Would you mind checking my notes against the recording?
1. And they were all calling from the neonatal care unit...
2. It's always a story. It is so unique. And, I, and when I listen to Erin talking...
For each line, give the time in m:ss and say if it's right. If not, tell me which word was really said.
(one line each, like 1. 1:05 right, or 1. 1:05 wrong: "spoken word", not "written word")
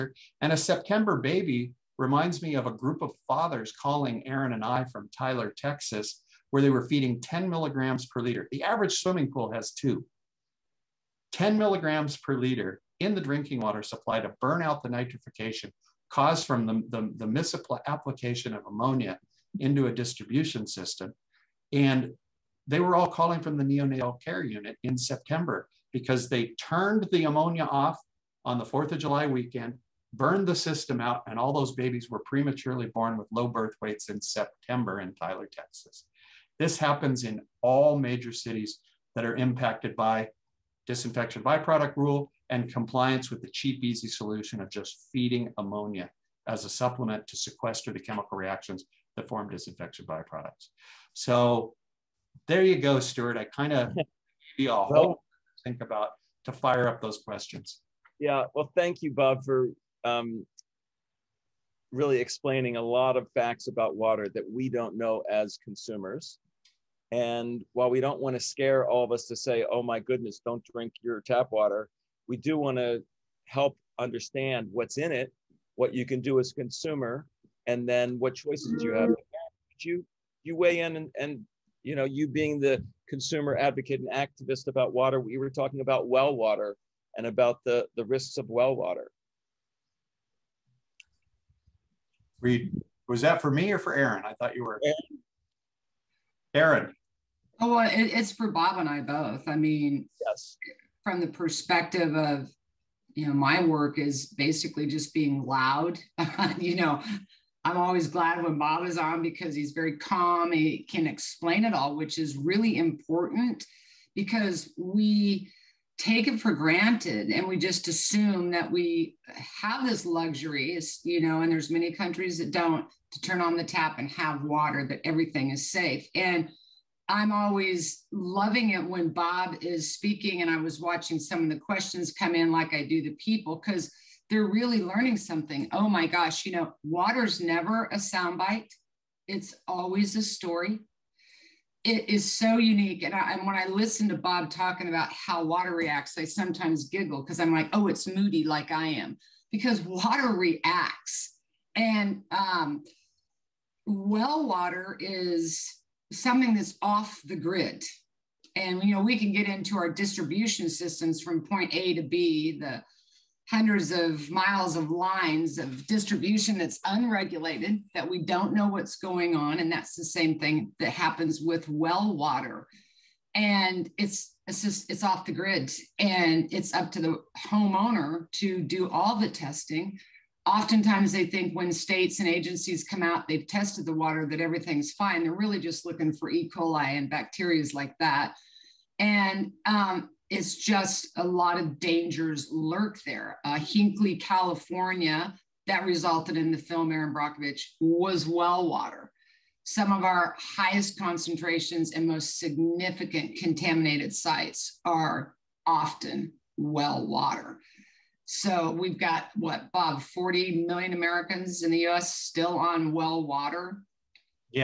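1. 0:21 right
2. 2:19 wrong: "Bob", not "Erin".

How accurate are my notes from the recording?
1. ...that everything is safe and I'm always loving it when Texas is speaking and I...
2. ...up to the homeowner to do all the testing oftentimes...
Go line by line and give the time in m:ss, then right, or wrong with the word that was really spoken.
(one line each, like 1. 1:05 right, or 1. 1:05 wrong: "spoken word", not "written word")
1. 2:04 wrong: "Bob", not "Texas"
2. 2:56 right.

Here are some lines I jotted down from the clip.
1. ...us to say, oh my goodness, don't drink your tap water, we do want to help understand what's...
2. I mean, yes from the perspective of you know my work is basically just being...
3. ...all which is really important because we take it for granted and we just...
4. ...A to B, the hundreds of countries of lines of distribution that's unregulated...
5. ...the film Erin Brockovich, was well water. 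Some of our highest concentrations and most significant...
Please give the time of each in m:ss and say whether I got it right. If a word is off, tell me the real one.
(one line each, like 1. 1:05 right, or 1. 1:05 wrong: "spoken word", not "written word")
1. 1:09 right
2. 1:39 right
3. 1:51 right
4. 2:41 wrong: "miles", not "countries"
5. 3:16 right.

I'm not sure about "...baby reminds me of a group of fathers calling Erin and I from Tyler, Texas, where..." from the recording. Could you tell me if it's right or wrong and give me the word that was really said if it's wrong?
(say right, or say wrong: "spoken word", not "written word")
right.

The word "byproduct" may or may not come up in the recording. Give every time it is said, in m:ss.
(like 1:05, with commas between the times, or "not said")
0:41, 0:50.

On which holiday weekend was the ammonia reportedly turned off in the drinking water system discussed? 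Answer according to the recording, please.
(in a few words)
4th of July.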